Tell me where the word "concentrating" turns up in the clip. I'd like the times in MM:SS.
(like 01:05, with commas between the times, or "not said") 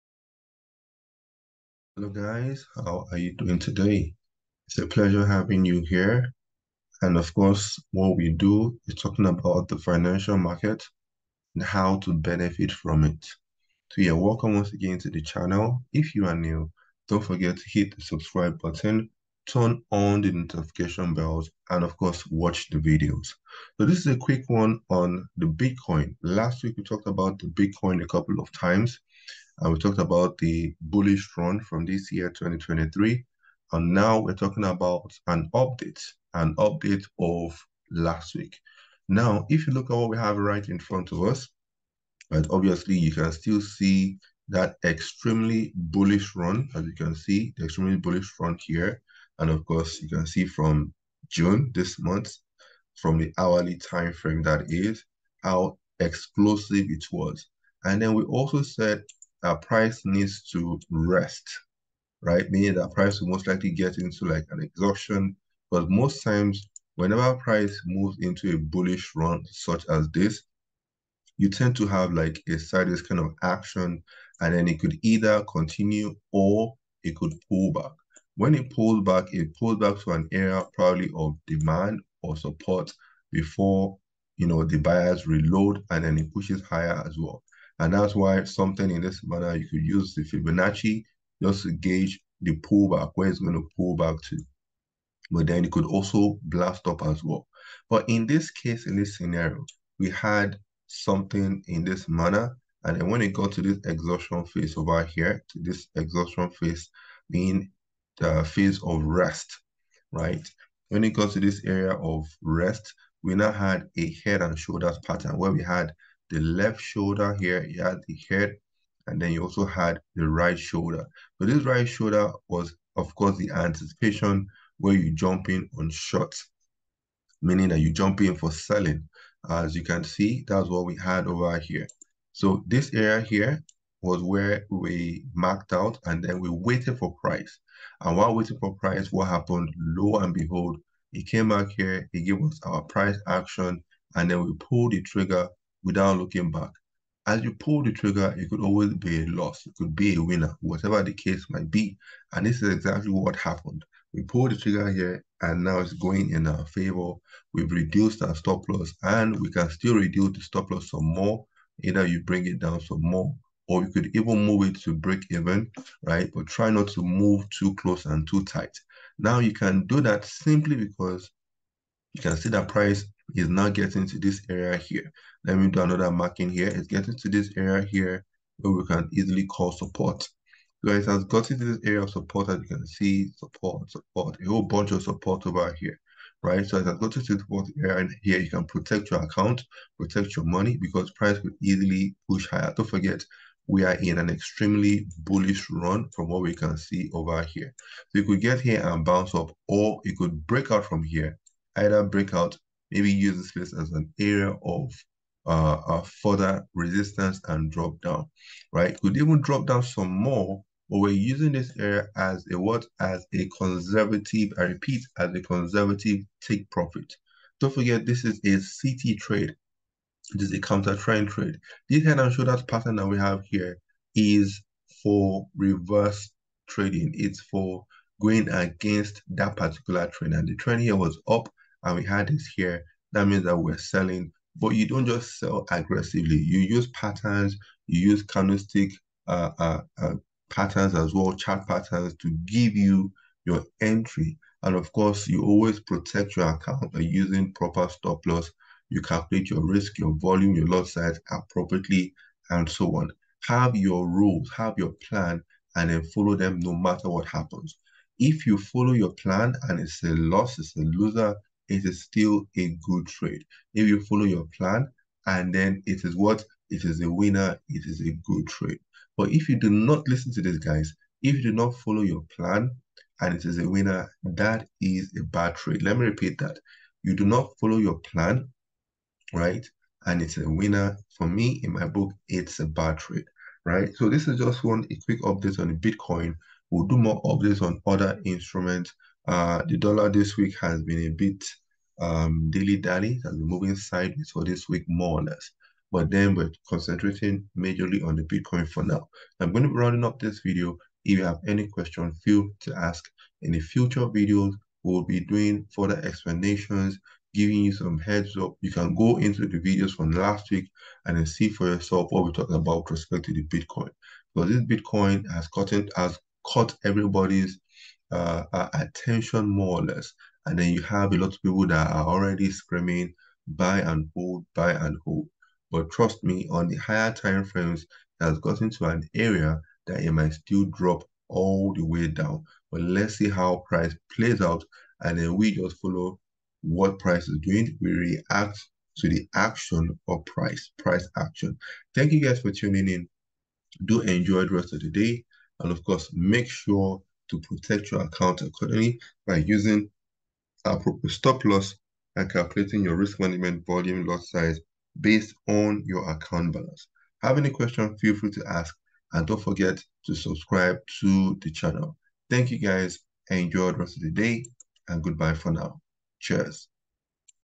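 04:56.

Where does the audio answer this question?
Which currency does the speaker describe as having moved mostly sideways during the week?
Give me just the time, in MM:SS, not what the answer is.
04:49.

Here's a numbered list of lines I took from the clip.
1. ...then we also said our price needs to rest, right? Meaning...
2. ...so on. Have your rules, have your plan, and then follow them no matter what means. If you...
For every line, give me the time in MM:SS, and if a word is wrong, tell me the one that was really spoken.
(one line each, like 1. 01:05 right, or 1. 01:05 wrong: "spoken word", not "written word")
1. 00:58 right
2. 04:12 wrong: "happens", not "means".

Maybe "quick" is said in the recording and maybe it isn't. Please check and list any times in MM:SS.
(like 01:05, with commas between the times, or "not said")
00:24, 04:45.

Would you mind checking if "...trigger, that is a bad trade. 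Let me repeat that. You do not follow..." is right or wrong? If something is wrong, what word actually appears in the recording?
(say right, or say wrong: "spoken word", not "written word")
wrong: "winner", not "trigger".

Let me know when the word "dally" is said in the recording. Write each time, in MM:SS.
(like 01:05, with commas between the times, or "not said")
04:52.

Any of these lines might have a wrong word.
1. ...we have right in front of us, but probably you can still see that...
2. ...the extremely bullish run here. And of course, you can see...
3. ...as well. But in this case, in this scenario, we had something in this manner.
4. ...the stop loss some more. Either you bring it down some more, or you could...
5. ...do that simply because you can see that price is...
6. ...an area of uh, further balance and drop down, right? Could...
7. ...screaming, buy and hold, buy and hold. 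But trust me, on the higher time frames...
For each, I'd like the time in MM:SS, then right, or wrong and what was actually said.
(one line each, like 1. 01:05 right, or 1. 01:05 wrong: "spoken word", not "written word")
1. 00:40 wrong: "obviously", not "probably"
2. 00:47 right
3. 01:37 right
4. 02:40 right
5. 02:49 right
6. 03:23 wrong: "resistance", not "balance"
7. 05:22 right.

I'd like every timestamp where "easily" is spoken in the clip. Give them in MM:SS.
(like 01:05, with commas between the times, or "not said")
02:59, 03:11.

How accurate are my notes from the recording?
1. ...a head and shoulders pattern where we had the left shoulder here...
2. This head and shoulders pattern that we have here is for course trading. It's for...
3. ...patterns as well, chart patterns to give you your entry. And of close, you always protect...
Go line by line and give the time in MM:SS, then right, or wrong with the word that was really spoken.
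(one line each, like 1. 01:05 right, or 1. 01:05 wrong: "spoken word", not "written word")
1. 01:53 right
2. 03:41 wrong: "reverse", not "course"
3. 04:00 wrong: "course", not "close".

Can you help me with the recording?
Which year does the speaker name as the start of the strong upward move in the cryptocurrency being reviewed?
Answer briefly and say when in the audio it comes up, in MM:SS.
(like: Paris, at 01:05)
2023, at 00:32.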